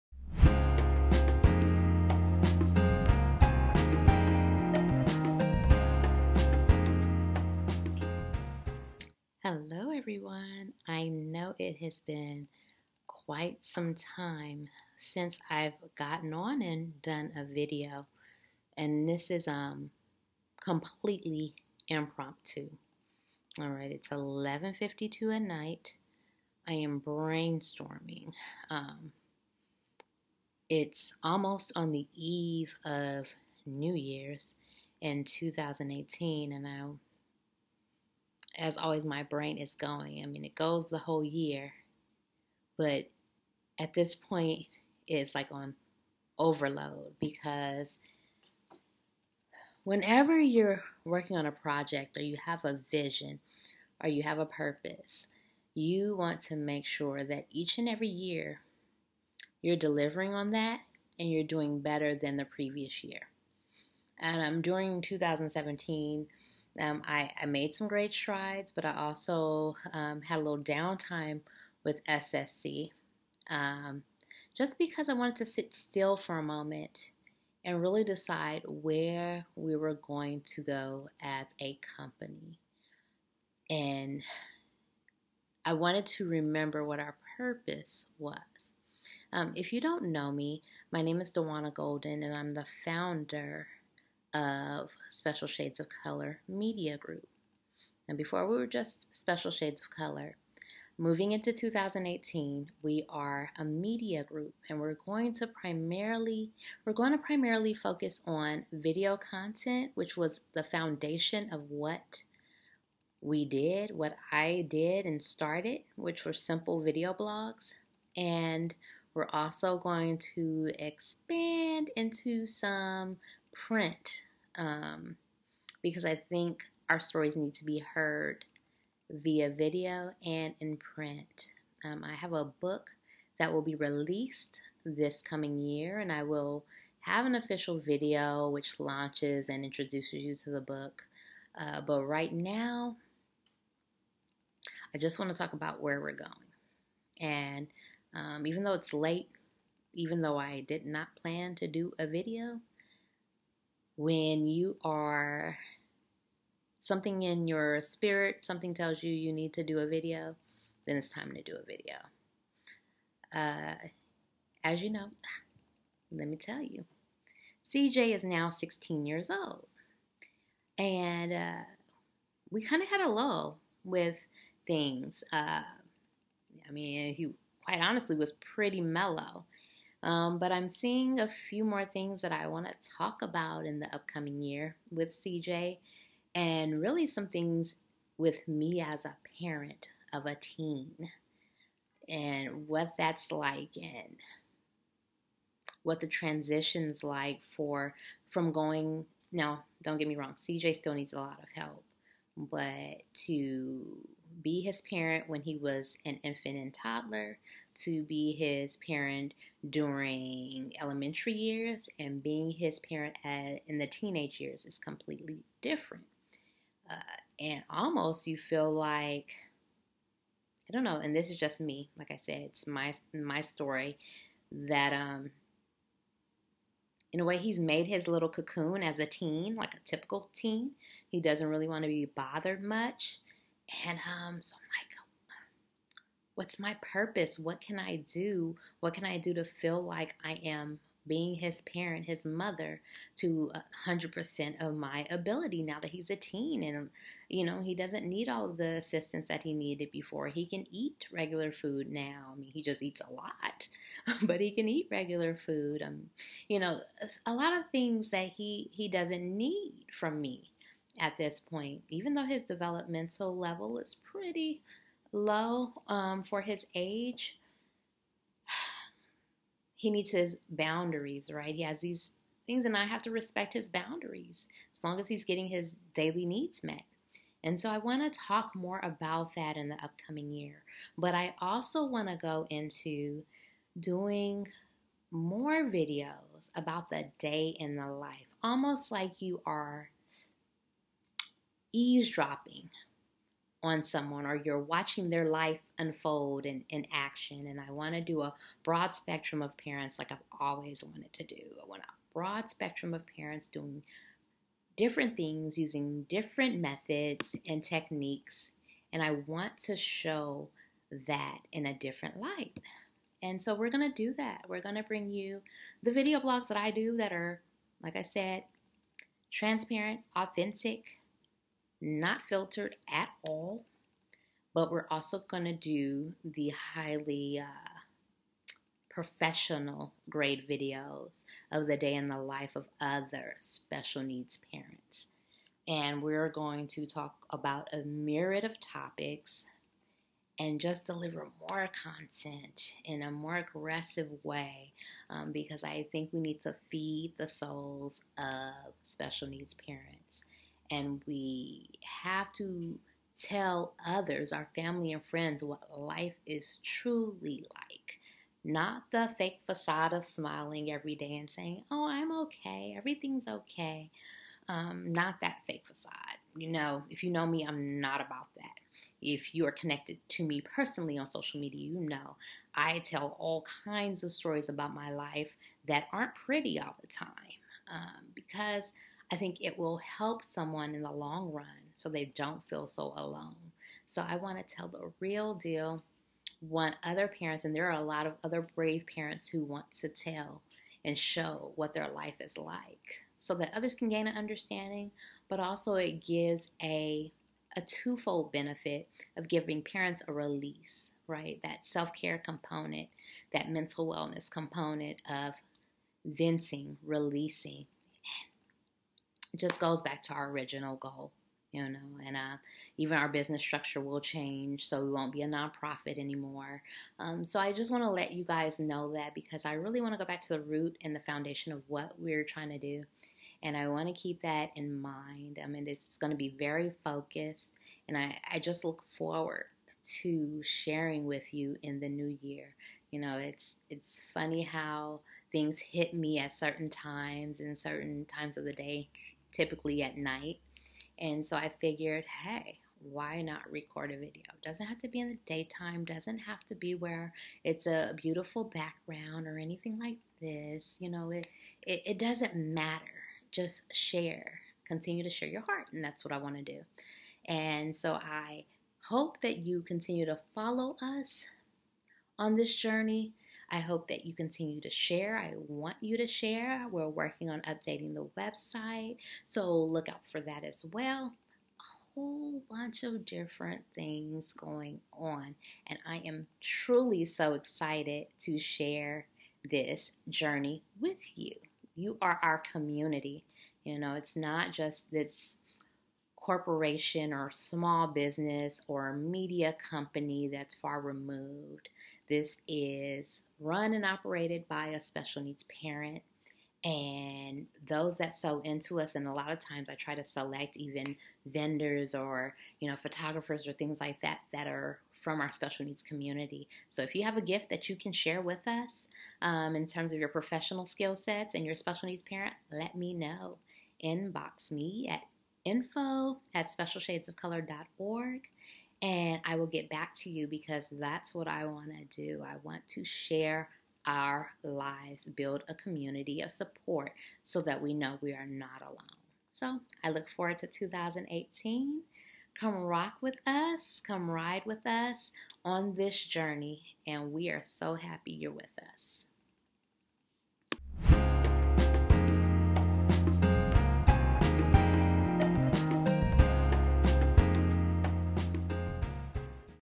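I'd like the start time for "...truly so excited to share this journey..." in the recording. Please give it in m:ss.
7:56.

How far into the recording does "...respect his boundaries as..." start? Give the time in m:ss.
4:33.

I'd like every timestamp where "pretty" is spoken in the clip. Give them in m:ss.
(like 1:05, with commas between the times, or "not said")
2:58, 4:24, 6:16.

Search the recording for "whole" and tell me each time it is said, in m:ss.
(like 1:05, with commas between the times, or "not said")
0:40, 7:51.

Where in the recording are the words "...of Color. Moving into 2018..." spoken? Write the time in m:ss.
1:39.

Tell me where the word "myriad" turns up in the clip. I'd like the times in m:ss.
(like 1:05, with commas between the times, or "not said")
5:37.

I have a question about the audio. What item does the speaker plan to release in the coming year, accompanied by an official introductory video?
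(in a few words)
a book.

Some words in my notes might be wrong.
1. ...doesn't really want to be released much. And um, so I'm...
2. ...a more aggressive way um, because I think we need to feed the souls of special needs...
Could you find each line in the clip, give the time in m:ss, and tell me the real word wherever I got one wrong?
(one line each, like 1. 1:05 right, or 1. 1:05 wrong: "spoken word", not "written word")
1. 3:51 wrong: "bothered", not "released"
2. 5:43 right.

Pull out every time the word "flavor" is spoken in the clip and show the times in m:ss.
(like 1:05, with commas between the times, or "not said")
not said.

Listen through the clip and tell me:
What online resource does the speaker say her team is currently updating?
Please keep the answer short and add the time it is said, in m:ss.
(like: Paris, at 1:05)
the website, at 7:47.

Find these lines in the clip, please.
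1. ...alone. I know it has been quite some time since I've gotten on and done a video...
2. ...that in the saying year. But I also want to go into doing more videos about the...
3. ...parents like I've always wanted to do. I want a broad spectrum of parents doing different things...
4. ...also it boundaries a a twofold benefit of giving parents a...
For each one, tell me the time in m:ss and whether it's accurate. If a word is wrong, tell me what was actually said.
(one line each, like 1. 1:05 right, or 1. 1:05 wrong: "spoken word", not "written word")
1. 0:09 wrong: "everyone", not "alone"
2. 4:39 wrong: "upcoming", not "saying"
3. 4:59 right
4. 6:35 wrong: "gives", not "boundaries".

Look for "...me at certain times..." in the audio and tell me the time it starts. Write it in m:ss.
7:15.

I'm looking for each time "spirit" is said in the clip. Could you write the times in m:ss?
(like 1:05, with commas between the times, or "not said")
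2:37.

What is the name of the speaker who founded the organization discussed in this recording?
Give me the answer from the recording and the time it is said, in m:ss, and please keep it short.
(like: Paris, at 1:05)
Dewana Golden, at 1:31.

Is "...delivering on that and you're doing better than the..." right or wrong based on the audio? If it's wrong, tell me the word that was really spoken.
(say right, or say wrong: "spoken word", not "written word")
right.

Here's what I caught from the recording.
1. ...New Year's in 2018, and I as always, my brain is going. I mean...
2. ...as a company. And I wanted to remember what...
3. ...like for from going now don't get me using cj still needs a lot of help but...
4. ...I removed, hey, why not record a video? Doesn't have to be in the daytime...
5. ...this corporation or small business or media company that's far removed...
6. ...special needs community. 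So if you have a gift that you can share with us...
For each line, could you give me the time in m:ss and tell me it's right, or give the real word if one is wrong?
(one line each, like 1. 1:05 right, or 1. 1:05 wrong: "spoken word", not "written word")
1. 0:33 right
2. 1:21 right
3. 3:17 wrong: "wrong", not "using"
4. 7:21 wrong: "figured", not "removed"
5. 8:04 right
6. 8:25 right.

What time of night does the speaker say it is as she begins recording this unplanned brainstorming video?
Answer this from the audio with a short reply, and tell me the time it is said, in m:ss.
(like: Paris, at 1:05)
11:52, at 0:24.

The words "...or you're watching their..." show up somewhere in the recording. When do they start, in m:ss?
4:54.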